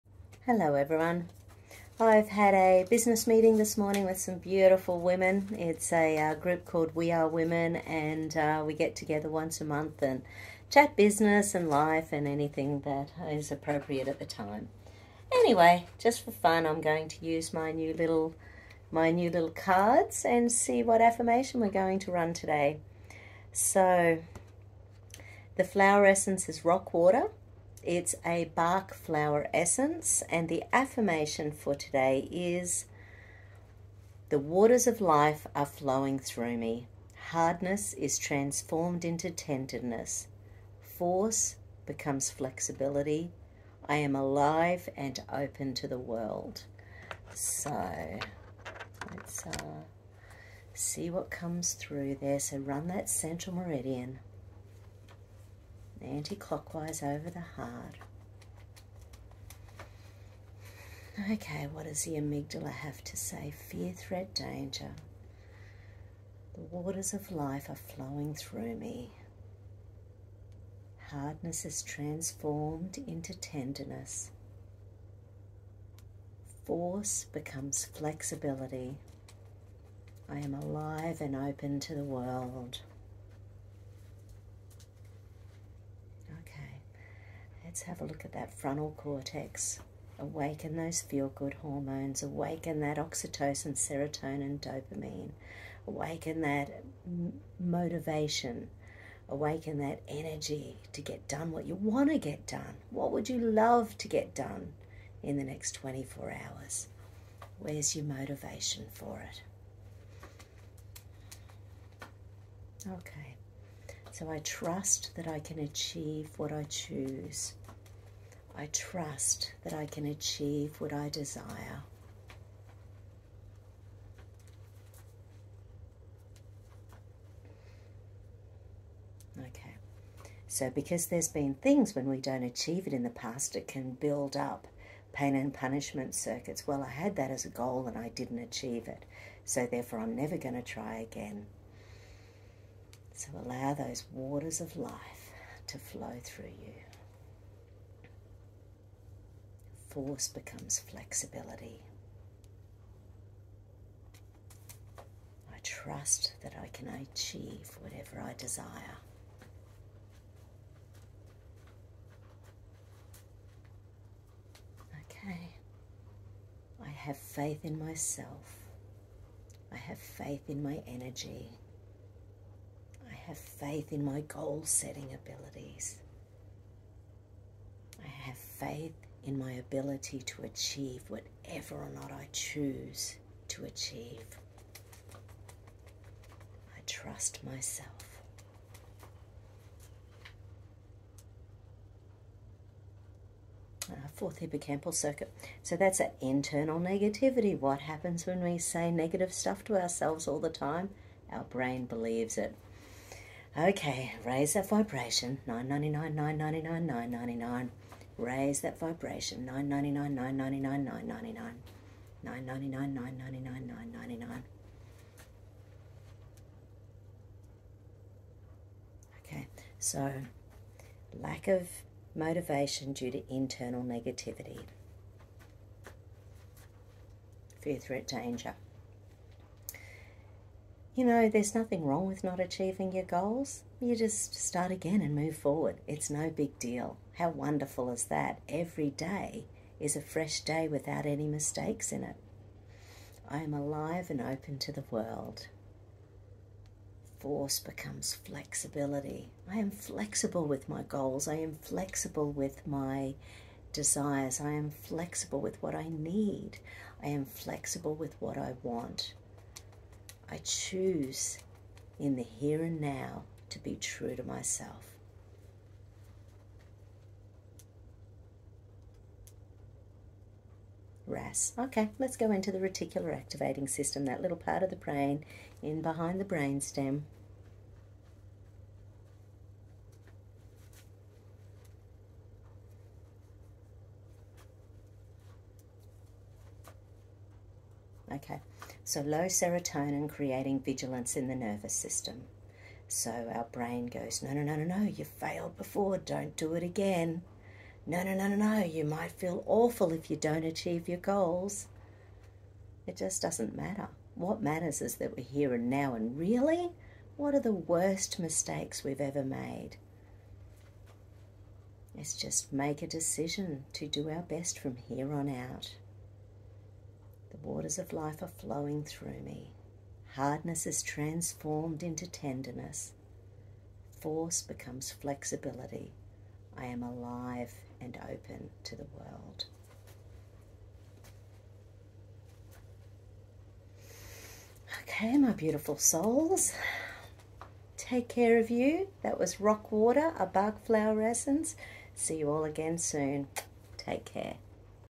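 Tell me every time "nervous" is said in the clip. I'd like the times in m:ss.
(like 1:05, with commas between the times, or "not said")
4:51.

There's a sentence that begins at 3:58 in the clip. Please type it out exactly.
Every day is a fresh day without any mistakes in it.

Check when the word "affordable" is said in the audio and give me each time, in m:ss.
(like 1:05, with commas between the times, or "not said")
not said.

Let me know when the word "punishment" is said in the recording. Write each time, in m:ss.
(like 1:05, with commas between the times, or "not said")
2:15.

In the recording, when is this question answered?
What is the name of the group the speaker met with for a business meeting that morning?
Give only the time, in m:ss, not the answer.
0:06.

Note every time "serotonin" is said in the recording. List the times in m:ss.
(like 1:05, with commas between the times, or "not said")
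1:33, 4:49.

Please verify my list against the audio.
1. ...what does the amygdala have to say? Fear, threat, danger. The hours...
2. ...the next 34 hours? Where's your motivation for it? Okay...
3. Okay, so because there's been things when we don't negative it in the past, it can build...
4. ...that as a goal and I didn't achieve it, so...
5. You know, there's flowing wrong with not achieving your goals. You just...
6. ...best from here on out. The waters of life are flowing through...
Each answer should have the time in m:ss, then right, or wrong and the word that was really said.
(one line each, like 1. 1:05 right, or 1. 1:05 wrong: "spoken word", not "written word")
1. 1:01 wrong: "waters", not "hours"
2. 1:45 wrong: "24", not "34"
3. 2:09 wrong: "achieve", not "negative"
4. 2:17 right
5. 3:50 wrong: "nothing", not "flowing"
6. 5:14 right.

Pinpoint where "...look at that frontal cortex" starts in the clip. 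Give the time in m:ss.
1:28.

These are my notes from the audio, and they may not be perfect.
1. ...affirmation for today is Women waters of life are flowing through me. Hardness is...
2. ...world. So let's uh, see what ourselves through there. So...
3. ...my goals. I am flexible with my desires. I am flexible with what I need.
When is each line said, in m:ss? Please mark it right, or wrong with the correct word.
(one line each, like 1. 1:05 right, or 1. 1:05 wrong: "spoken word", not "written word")
1. 0:30 wrong: "The", not "Women"
2. 0:45 wrong: "comes", not "ourselves"
3. 4:10 right.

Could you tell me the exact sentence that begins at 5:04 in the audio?
What matters is that we're here and now, and really, what are the worst mistakes we've ever made?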